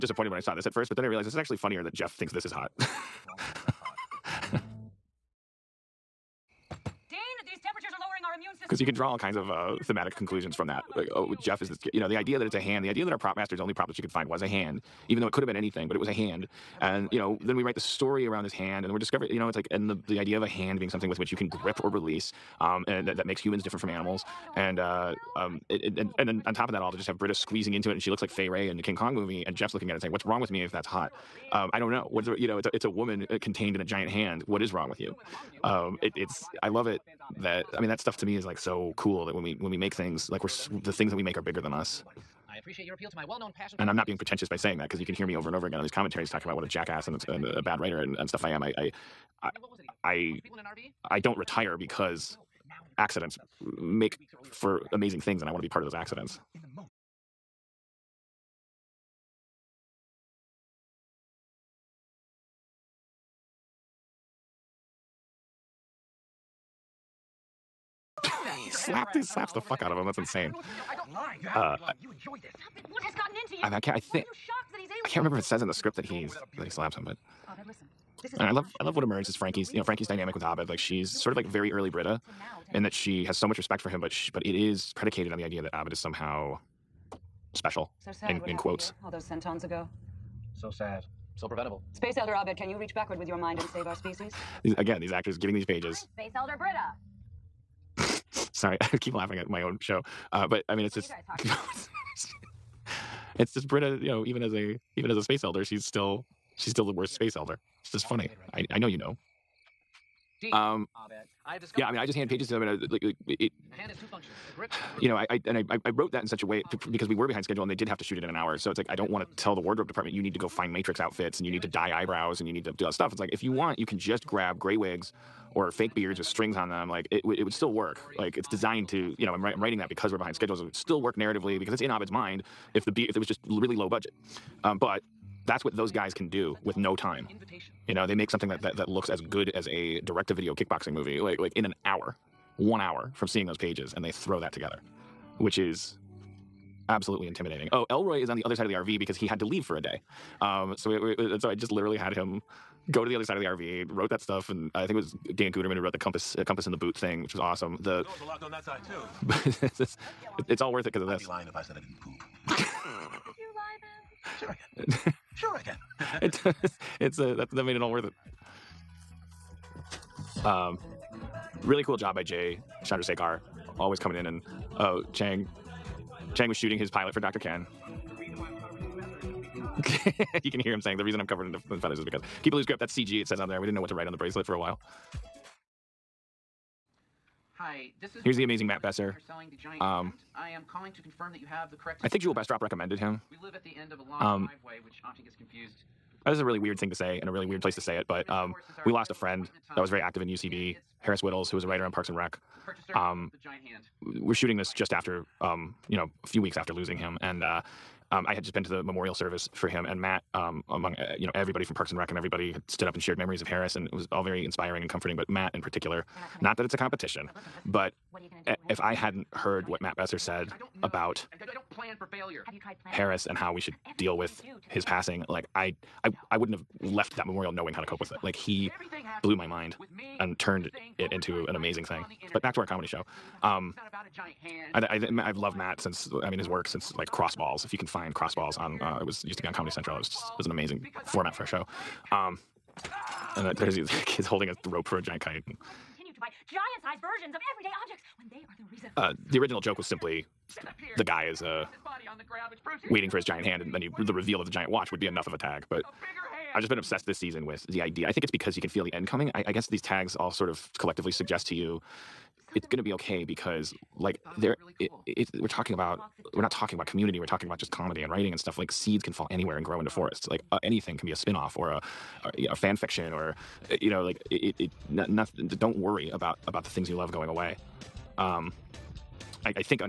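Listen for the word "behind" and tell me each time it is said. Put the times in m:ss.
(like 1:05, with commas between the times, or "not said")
1:57, 2:10.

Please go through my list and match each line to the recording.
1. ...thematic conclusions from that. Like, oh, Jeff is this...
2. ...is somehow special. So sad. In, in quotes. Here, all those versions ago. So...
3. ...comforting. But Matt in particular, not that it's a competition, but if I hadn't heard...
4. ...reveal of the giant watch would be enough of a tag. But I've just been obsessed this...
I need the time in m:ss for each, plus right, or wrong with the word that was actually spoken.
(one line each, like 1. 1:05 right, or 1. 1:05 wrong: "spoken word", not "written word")
1. 0:09 right
2. 1:25 wrong: "centons", not "versions"
3. 3:34 right
4. 4:14 right.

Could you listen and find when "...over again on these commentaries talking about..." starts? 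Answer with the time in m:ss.
0:45.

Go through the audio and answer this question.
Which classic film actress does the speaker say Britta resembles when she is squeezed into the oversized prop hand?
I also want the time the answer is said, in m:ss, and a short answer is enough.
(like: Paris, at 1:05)
Fay Wray, at 0:28.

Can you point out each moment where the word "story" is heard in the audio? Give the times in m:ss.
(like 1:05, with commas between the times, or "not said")
0:17.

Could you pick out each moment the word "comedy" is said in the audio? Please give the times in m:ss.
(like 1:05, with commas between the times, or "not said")
3:52, 3:59, 4:27.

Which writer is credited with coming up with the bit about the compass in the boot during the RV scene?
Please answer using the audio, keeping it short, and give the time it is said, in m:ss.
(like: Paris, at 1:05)
Dan Guterman, at 2:35.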